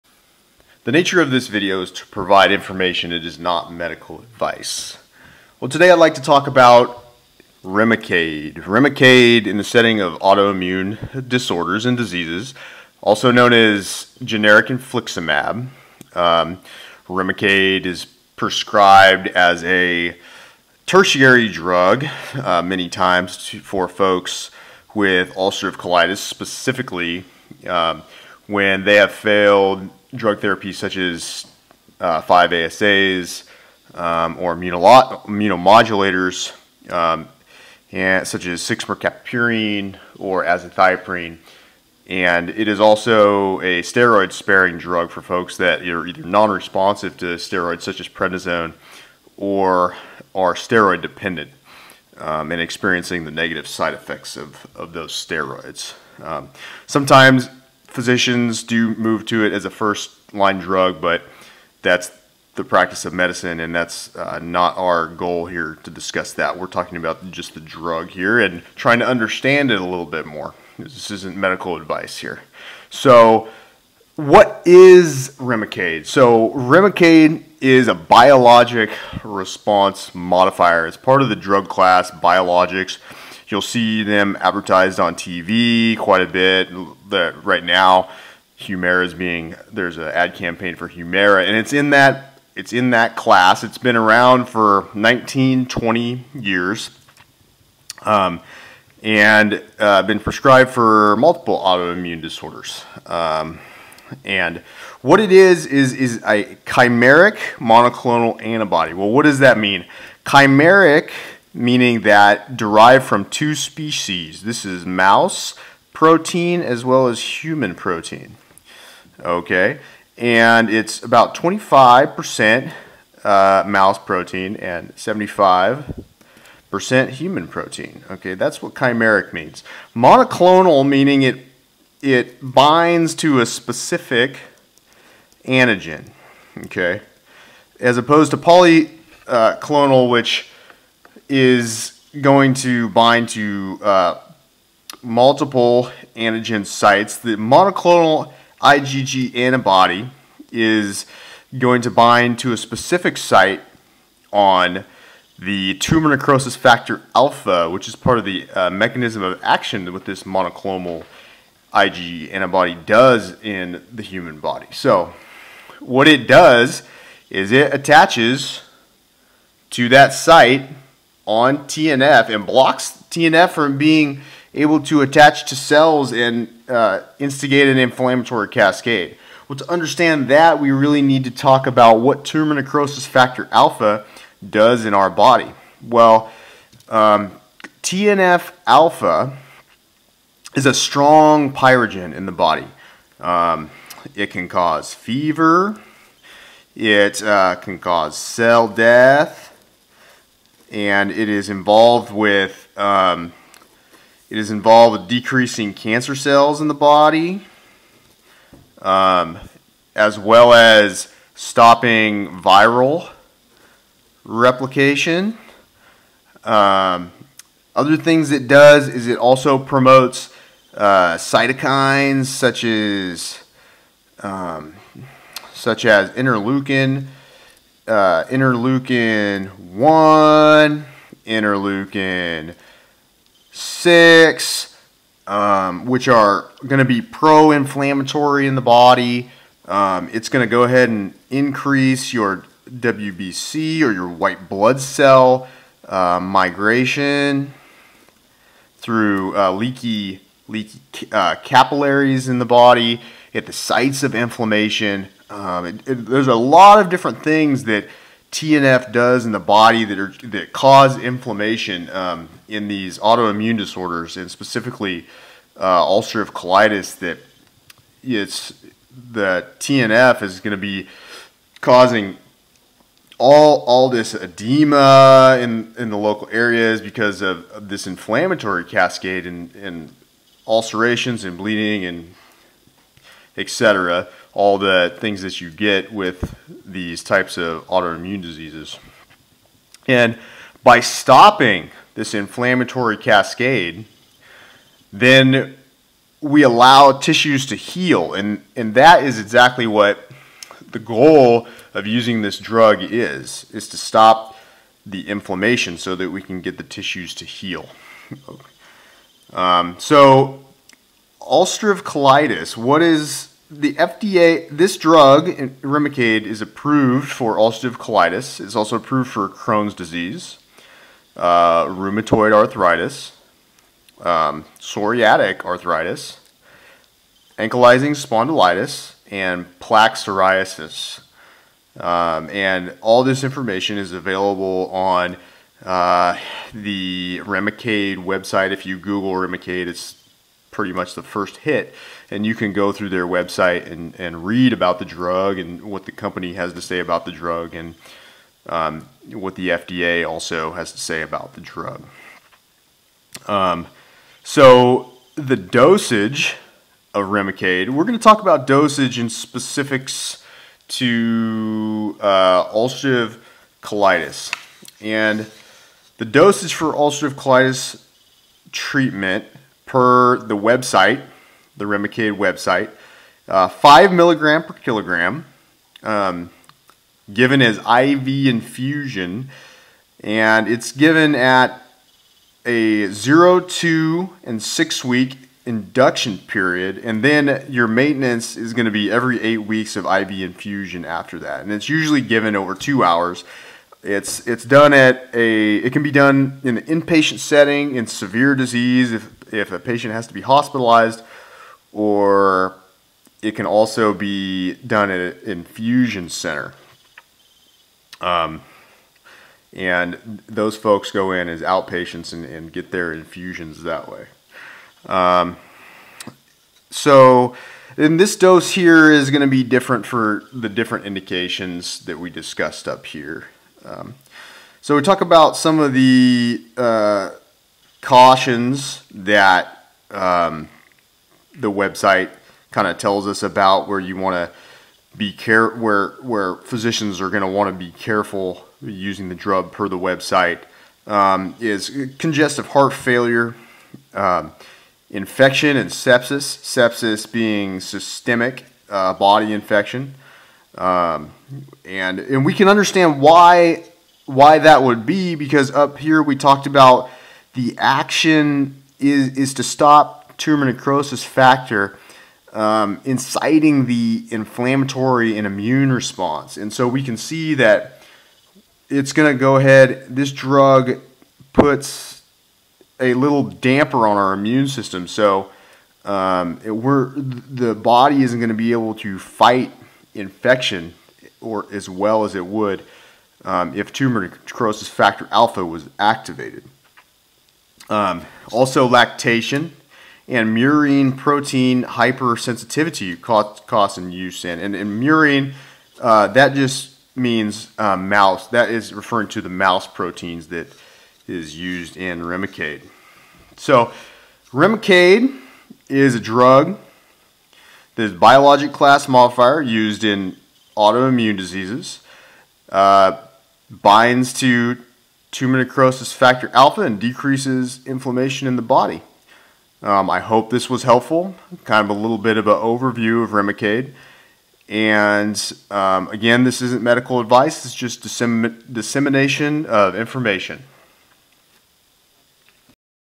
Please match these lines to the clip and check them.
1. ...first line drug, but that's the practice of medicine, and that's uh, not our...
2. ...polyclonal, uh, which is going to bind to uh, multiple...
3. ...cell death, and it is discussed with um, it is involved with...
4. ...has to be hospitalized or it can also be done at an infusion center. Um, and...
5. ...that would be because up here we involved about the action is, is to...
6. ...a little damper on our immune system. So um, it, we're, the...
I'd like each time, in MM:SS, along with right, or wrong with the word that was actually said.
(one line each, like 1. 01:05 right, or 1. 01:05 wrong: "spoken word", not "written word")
1. 00:59 right
2. 02:18 right
3. 03:18 wrong: "involved", not "discussed"
4. 06:39 right
5. 07:34 wrong: "talked", not "involved"
6. 07:52 right.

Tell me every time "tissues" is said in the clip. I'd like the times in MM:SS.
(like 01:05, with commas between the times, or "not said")
04:56, 05:06.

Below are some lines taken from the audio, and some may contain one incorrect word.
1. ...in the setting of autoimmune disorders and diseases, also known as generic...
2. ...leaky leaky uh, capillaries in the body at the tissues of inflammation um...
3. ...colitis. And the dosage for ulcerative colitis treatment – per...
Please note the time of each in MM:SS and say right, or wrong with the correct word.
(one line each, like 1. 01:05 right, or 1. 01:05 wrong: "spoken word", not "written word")
1. 00:09 right
2. 04:09 wrong: "sites", not "tissues"
3. 06:03 right.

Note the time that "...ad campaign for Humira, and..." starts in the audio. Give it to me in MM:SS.
01:30.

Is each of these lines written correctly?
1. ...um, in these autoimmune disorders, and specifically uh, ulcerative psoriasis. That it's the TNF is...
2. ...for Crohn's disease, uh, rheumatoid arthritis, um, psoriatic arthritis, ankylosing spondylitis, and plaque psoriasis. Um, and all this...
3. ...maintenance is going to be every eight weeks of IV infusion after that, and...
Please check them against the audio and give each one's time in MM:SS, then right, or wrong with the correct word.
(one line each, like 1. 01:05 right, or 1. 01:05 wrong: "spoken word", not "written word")
1. 04:21 wrong: "colitis", not "psoriasis"
2. 05:19 right
3. 06:27 right.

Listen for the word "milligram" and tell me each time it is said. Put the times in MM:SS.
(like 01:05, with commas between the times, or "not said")
06:13.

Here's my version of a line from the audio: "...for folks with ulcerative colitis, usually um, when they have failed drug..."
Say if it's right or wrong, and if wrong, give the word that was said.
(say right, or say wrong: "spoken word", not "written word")
wrong: "specifically", not "usually".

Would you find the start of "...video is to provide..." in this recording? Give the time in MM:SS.
00:01.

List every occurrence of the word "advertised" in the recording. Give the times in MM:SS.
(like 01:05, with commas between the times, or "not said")
01:24.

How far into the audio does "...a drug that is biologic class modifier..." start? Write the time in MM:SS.
08:25.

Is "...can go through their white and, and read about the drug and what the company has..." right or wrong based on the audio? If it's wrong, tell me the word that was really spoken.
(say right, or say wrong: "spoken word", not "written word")
wrong: "website", not "white".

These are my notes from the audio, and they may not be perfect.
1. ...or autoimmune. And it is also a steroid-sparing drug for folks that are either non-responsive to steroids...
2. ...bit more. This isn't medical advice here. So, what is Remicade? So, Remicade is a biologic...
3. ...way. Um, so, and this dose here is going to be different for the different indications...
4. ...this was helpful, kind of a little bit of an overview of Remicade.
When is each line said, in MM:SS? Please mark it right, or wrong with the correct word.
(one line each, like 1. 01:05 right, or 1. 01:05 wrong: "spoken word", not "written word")
1. 00:40 wrong: "azathioprine", not "autoimmune"
2. 01:10 right
3. 06:53 right
4. 08:40 right.